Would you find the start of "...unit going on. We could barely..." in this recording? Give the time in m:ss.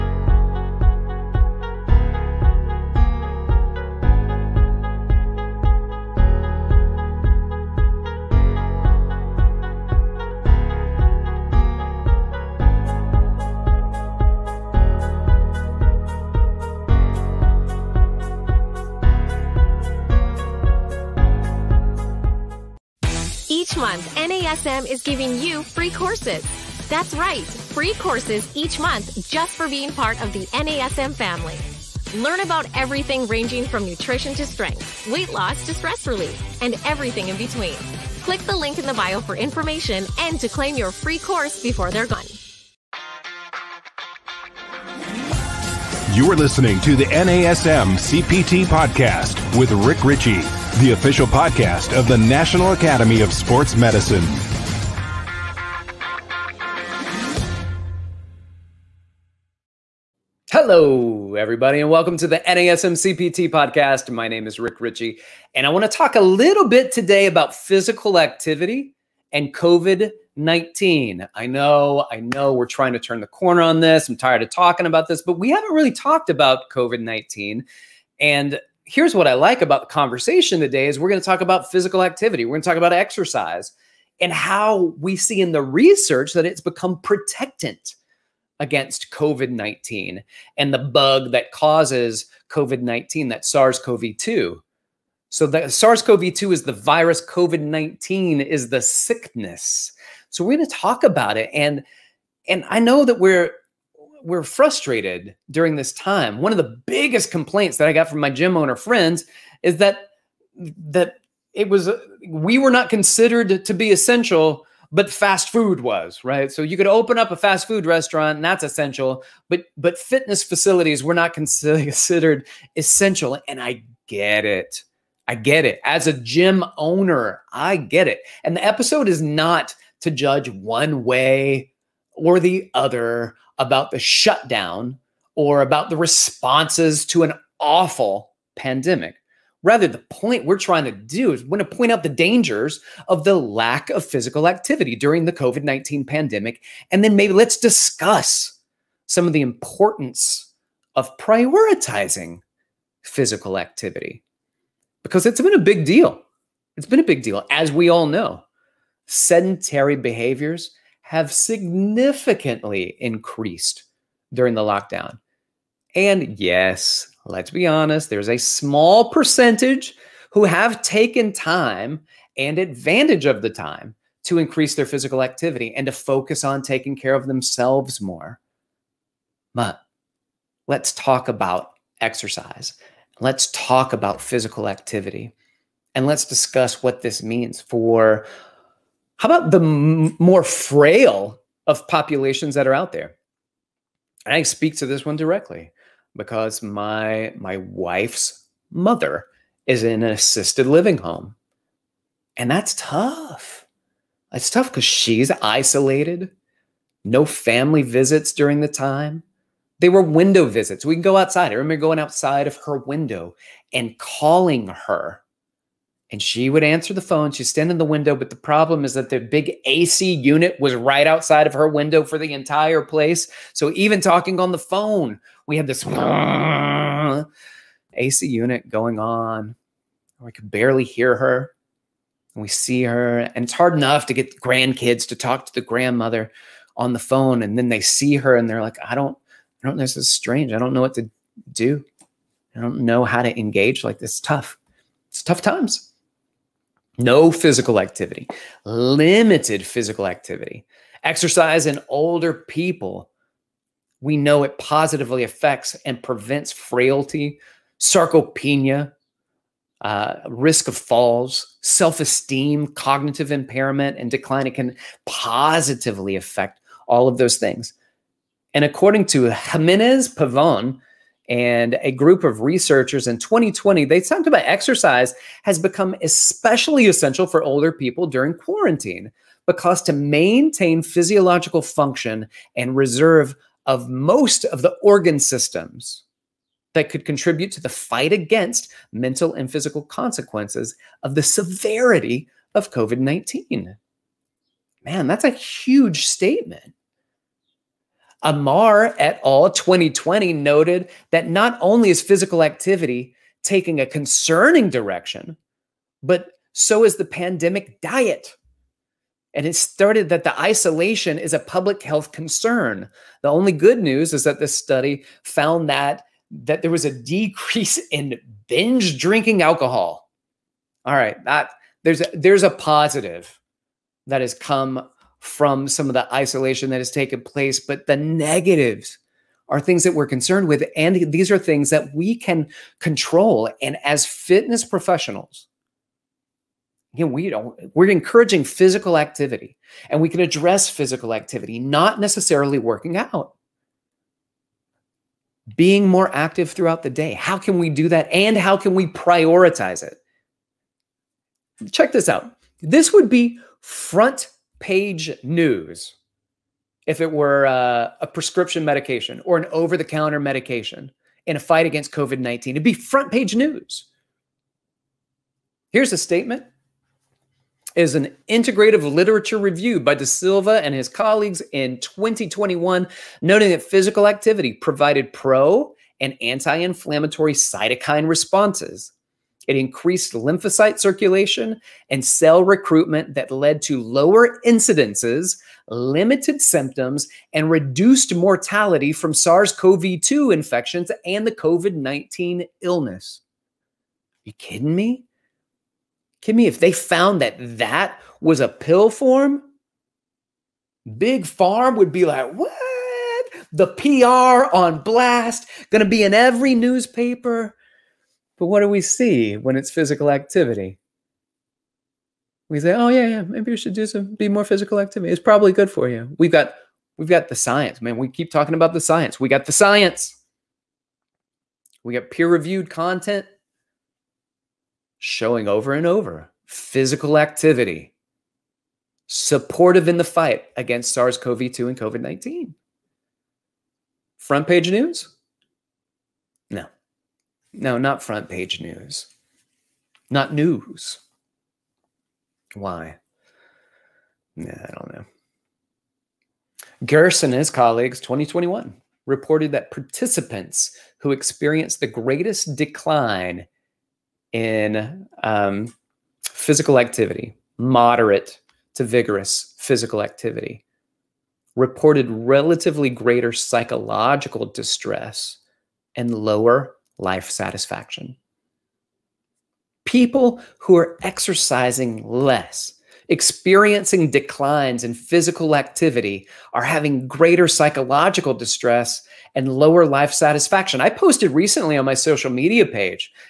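3:48.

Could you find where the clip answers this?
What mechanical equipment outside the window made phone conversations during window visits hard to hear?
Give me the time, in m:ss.
3:39.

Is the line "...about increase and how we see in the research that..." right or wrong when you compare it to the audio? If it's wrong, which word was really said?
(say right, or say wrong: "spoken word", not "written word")
wrong: "exercise", not "increase".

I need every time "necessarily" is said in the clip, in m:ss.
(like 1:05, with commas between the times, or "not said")
5:42.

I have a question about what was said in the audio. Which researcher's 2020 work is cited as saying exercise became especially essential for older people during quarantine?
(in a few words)
Jimenez Pavon.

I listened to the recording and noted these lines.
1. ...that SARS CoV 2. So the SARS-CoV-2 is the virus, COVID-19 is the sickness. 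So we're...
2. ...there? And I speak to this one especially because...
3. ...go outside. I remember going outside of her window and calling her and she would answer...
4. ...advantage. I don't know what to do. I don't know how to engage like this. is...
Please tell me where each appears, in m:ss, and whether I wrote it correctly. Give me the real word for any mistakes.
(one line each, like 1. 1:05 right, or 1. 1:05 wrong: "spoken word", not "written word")
1. 1:33 right
2. 3:12 wrong: "directly", not "especially"
3. 3:31 right
4. 4:00 wrong: "strange", not "advantage".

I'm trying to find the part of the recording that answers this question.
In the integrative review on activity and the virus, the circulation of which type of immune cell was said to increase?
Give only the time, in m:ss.
6:20.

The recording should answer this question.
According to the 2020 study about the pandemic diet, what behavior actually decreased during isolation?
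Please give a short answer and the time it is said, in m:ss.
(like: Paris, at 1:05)
binge drinking alcohol, at 5:18.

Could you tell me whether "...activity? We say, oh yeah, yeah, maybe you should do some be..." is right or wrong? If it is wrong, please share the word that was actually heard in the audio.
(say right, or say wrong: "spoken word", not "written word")
right.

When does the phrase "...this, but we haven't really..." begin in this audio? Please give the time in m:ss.
1:15.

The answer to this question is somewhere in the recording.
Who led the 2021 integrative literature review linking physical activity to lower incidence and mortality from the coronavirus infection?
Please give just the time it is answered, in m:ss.
6:09.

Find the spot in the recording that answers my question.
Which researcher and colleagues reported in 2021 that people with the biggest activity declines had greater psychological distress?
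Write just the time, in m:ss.
7:26.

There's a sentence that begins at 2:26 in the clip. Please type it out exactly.
And then maybe let's discuss some of the importance of prioritizing physical activity because it's been a big deal.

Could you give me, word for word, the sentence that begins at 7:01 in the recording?
We got peer-reviewed content showing over and over physical activity supportive in the fight against SARS-CoV-2 and COVID-19.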